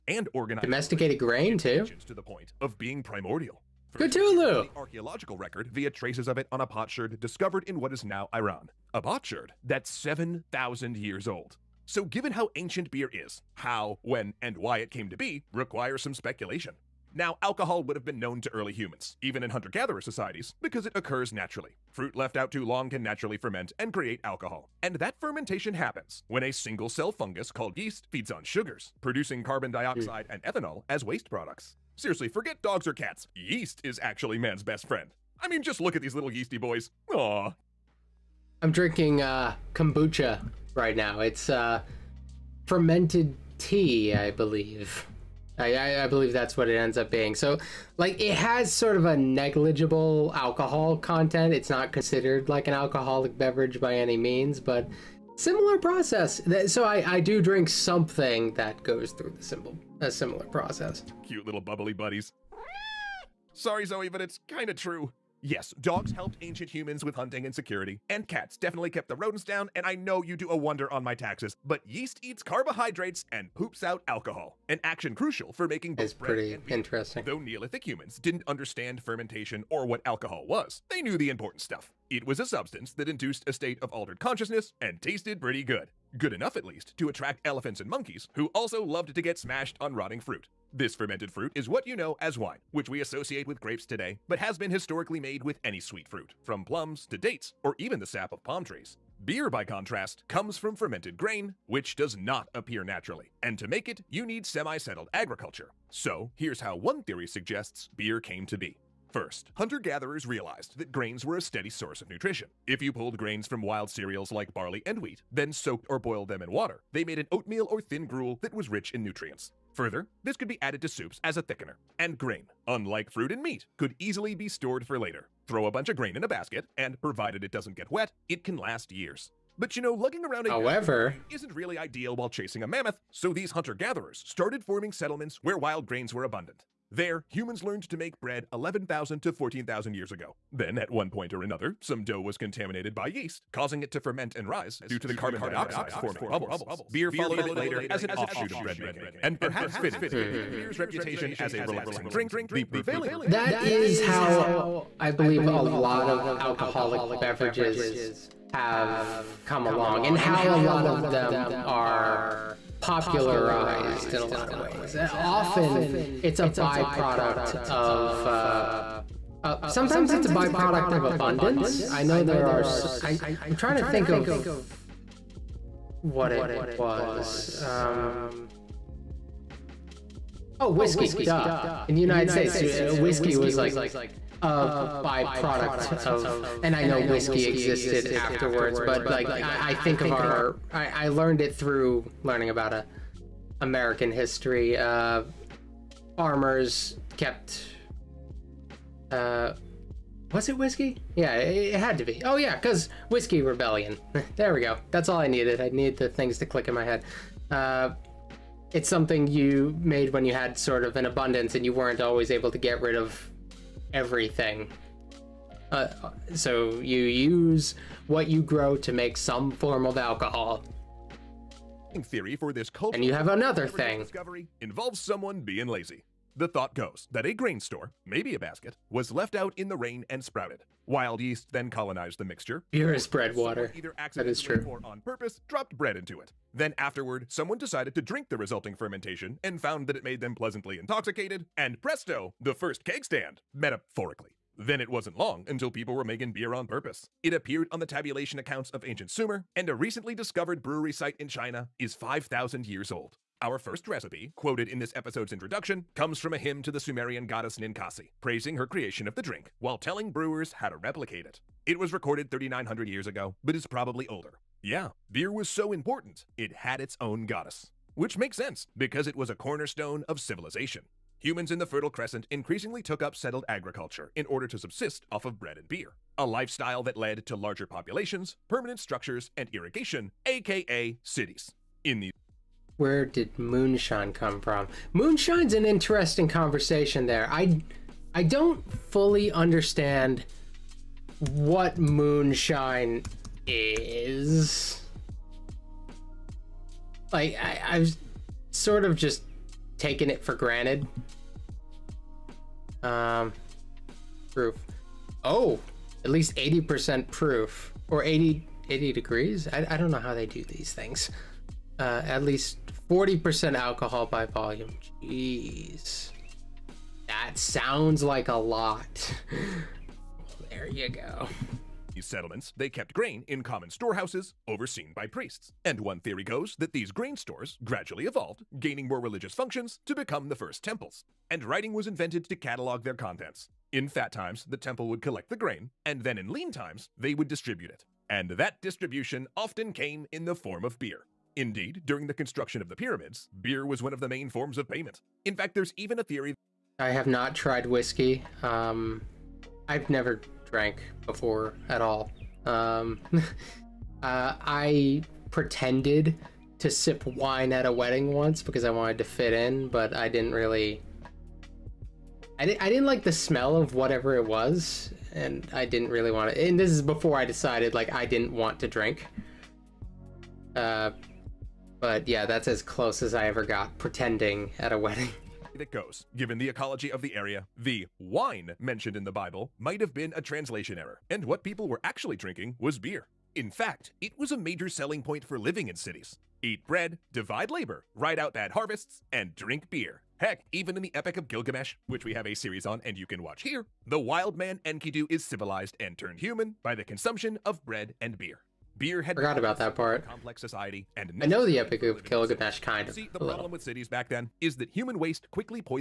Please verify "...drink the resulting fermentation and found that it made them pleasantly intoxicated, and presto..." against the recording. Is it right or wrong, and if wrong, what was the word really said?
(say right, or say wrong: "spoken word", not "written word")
right.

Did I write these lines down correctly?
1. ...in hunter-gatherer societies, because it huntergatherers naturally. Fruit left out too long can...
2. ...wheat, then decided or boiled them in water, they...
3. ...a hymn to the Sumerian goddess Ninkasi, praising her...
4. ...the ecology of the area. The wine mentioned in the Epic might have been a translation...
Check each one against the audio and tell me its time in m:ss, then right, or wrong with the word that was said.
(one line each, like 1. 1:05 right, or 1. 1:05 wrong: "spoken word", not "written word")
1. 0:19 wrong: "occurs", not "huntergatherers"
2. 1:55 wrong: "soaked", not "decided"
3. 4:16 right
4. 6:16 wrong: "Bible", not "Epic".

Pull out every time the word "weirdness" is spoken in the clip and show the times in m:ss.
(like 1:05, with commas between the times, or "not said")
not said.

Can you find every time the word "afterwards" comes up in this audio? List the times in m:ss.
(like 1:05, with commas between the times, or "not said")
3:08, 3:56.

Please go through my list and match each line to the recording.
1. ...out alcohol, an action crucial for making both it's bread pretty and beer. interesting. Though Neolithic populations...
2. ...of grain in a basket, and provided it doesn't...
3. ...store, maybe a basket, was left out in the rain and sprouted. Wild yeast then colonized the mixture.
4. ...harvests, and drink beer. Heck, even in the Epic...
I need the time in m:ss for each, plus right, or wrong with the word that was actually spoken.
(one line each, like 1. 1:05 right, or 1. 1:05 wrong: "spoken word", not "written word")
1. 1:13 wrong: "humans", not "populations"
2. 2:05 right
3. 3:47 right
4. 6:28 right.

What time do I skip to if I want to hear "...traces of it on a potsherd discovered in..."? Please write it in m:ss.
0:05.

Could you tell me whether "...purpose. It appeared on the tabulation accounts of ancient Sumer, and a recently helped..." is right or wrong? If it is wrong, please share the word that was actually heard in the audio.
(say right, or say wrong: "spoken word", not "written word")
wrong: "discovered", not "helped".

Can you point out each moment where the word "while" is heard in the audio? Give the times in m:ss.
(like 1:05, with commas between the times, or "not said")
2:12, 4:19.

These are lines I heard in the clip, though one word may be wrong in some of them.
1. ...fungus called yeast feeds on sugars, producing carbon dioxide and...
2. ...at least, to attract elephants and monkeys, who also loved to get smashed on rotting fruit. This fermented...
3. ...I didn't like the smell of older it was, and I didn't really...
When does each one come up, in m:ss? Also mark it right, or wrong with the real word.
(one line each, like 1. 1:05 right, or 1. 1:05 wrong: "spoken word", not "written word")
1. 0:27 right
2. 1:26 right
3. 6:02 wrong: "whatever", not "older".